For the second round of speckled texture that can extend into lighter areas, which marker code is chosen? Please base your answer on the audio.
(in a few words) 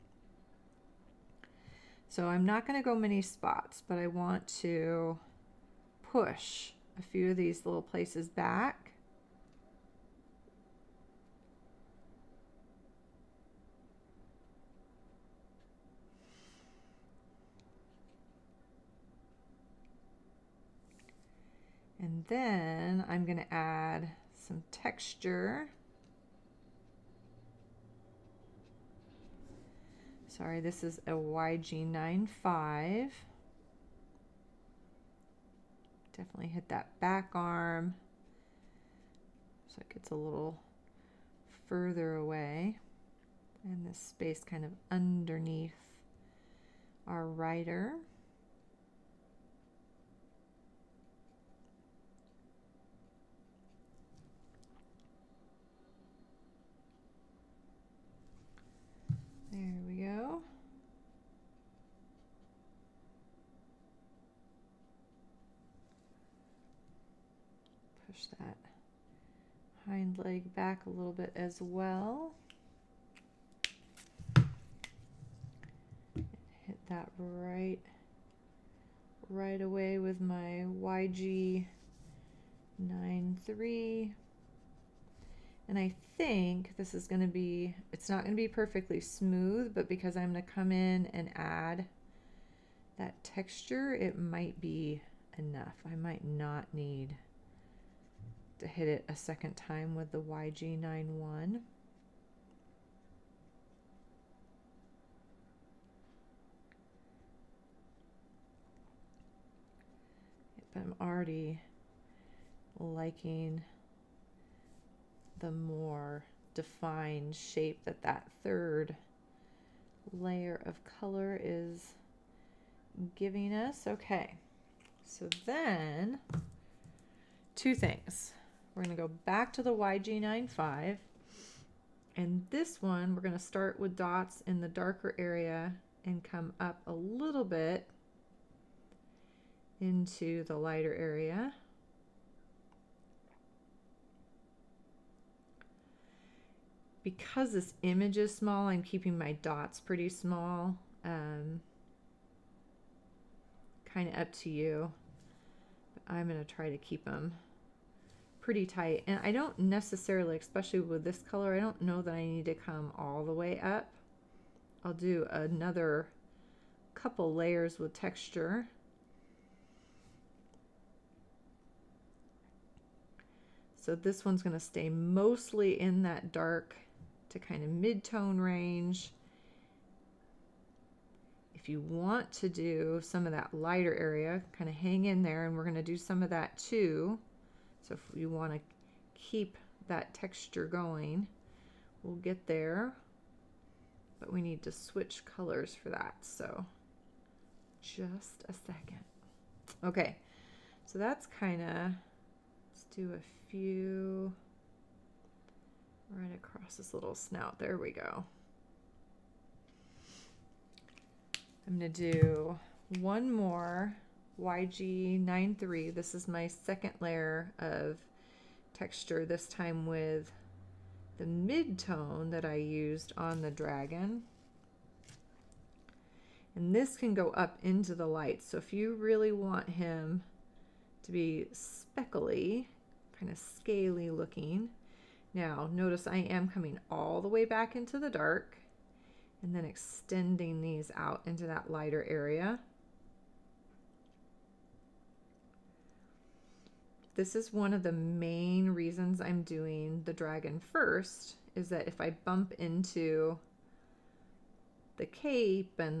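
YG93.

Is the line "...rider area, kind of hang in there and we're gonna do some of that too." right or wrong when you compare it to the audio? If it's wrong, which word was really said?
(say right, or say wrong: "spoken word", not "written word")
wrong: "lighter", not "rider".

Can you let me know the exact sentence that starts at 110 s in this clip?
But I'm already liking the more defined shape that that third layer of color is giving us.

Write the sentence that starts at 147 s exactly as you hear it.
because this image is small, I'm keeping my dots pretty small.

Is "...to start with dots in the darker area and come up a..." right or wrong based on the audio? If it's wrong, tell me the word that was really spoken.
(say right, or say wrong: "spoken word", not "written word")
right.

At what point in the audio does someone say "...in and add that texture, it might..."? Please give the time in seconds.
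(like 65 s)
90 s.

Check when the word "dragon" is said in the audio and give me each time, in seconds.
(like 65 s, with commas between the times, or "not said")
223 s, 250 s.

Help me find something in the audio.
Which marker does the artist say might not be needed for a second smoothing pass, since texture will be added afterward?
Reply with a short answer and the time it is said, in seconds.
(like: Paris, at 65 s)
YG91, at 100 s.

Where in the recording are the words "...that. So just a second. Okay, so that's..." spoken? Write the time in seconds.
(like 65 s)
195 s.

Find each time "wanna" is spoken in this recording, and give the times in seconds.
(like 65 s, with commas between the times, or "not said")
188 s.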